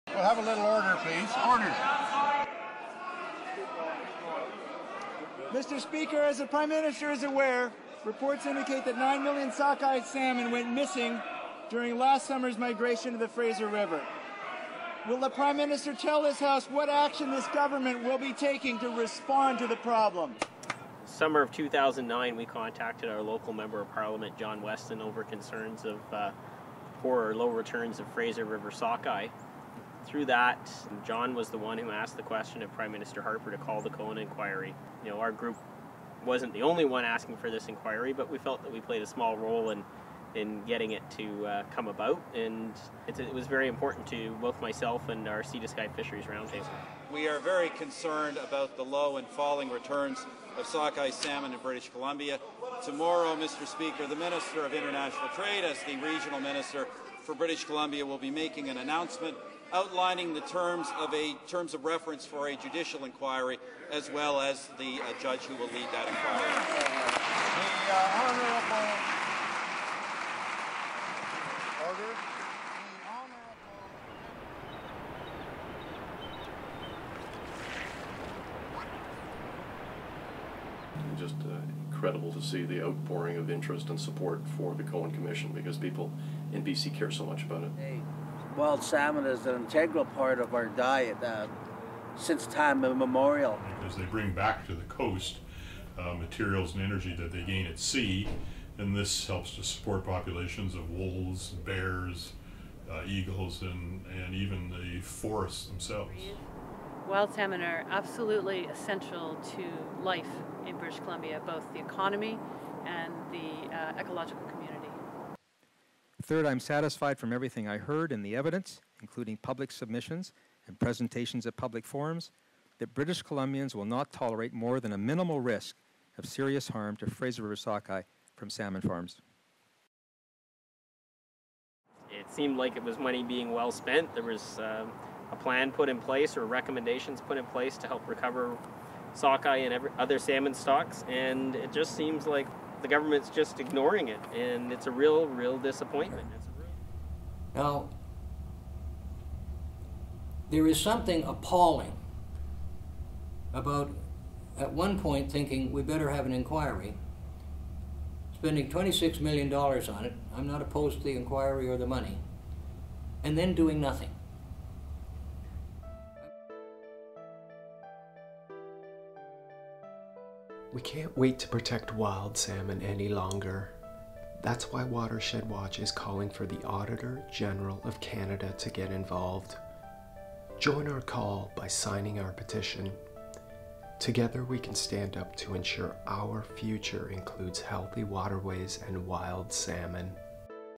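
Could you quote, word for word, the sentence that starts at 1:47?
Wild salmon are absolutely essential to life in British Columbia, both the economy and the uh, ecological community.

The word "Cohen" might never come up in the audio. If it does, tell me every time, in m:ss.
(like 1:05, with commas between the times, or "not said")
0:33, 1:24.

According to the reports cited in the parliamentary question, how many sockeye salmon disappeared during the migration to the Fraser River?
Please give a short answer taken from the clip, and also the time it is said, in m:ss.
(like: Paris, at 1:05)
9 million, at 0:08.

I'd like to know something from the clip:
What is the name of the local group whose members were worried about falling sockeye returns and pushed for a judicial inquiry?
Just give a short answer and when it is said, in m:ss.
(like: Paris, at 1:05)
Sea to Sky Fisheries Roundtable, at 0:45.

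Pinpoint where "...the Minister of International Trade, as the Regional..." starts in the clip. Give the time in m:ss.
0:54.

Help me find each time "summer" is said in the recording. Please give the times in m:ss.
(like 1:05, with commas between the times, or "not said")
0:12, 0:21.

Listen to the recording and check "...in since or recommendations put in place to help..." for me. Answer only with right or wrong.
wrong.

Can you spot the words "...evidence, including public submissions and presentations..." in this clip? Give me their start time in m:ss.
1:58.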